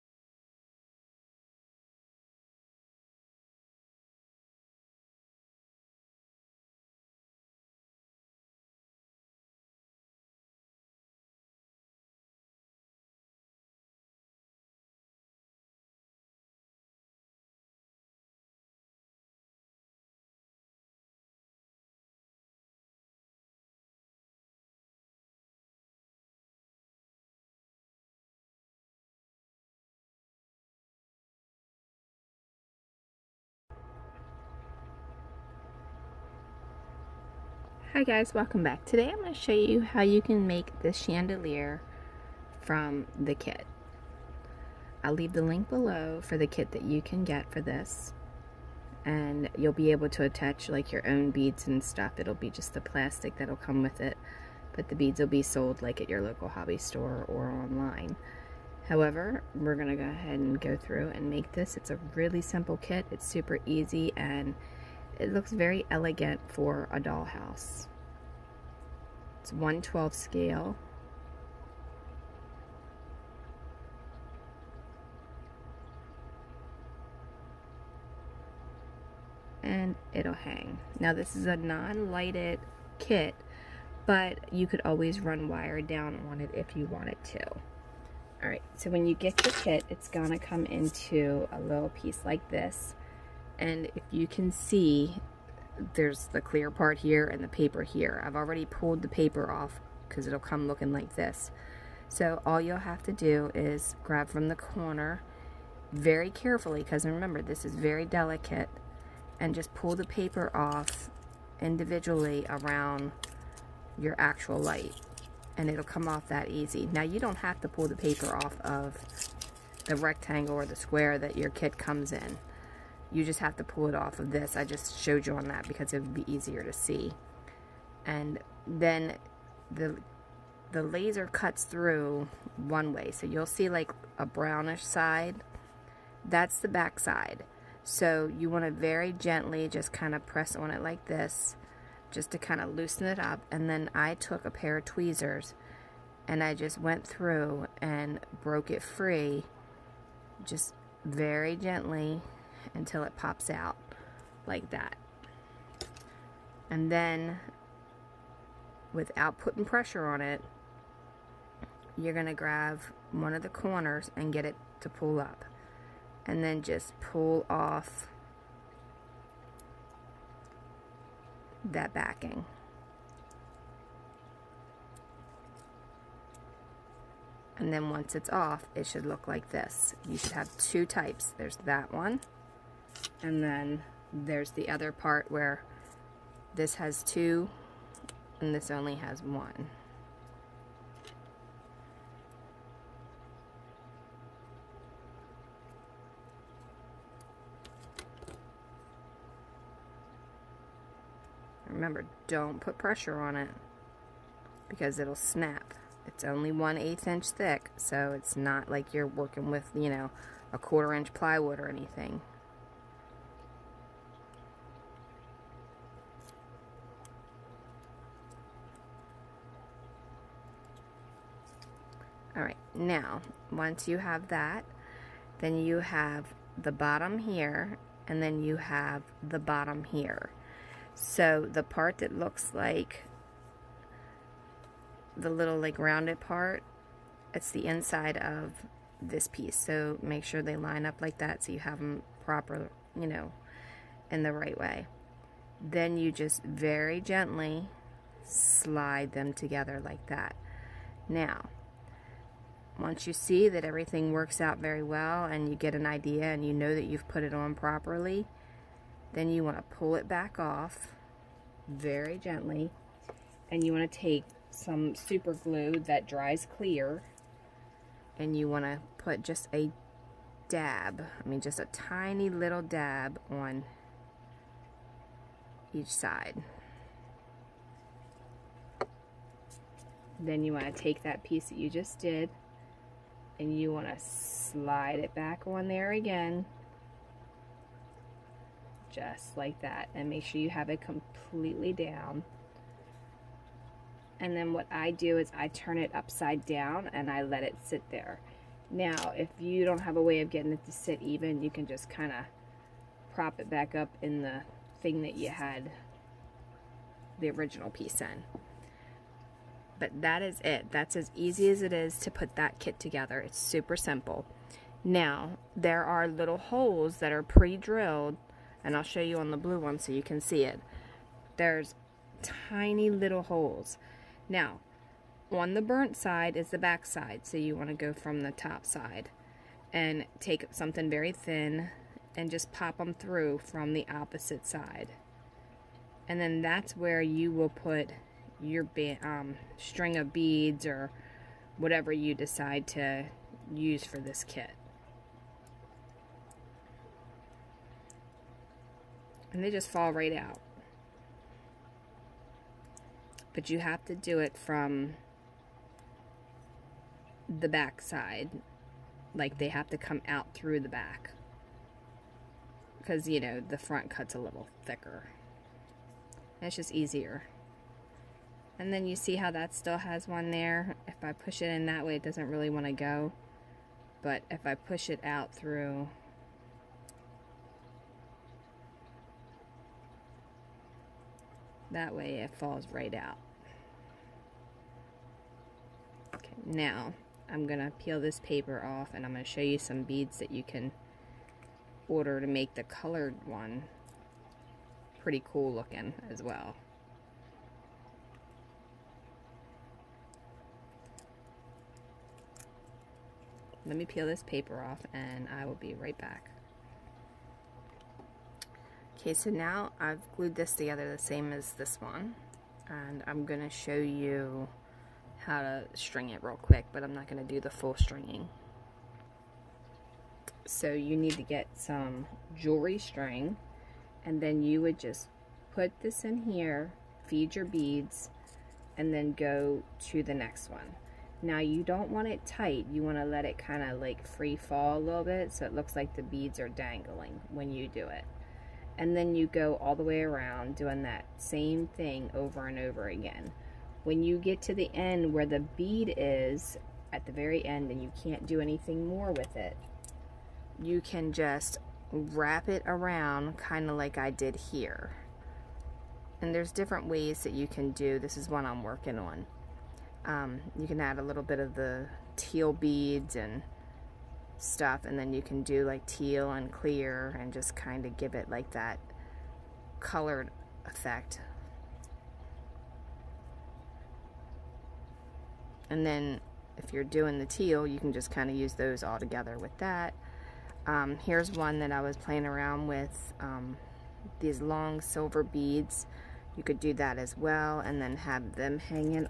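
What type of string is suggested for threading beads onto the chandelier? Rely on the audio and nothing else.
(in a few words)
jewelry string.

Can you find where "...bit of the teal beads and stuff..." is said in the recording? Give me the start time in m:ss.
7:41.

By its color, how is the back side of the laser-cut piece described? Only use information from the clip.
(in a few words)
brownish side.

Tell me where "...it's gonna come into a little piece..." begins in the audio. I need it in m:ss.
1:29.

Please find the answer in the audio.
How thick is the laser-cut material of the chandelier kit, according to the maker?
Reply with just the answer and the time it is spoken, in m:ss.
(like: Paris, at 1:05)
1/8 inch, at 3:26.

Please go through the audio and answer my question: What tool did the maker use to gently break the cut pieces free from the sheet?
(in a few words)
tweezers.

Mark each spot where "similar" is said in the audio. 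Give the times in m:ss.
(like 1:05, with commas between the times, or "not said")
not said.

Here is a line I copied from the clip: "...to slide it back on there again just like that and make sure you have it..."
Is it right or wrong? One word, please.
right.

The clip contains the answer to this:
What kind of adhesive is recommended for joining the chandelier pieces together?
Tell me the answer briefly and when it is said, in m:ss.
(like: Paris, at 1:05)
super glue that dries clear, at 4:24.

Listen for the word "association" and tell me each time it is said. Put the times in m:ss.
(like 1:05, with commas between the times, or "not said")
not said.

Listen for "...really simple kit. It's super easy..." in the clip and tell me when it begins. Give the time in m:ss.
1:02.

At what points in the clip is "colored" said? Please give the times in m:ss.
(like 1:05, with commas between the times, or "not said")
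6:32, 7:49.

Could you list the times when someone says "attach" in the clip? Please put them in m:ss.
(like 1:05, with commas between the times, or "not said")
0:50.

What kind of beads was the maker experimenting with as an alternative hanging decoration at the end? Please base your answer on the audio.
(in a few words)
long silver beads.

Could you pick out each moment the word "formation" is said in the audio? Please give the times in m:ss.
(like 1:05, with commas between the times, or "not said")
not said.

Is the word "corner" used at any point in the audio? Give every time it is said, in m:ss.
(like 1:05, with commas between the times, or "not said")
1:44, 2:43.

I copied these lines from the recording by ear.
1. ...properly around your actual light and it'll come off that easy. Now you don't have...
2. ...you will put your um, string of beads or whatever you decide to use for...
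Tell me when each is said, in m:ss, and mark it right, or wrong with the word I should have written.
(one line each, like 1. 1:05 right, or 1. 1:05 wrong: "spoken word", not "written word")
1. 1:51 wrong: "individually", not "properly"
2. 5:37 right.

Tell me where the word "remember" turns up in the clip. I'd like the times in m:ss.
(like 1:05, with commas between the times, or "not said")
1:47, 3:21.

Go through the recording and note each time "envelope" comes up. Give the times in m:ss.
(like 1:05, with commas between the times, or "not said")
not said.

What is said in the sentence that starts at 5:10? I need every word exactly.
That's as easy as it is to put that kit together.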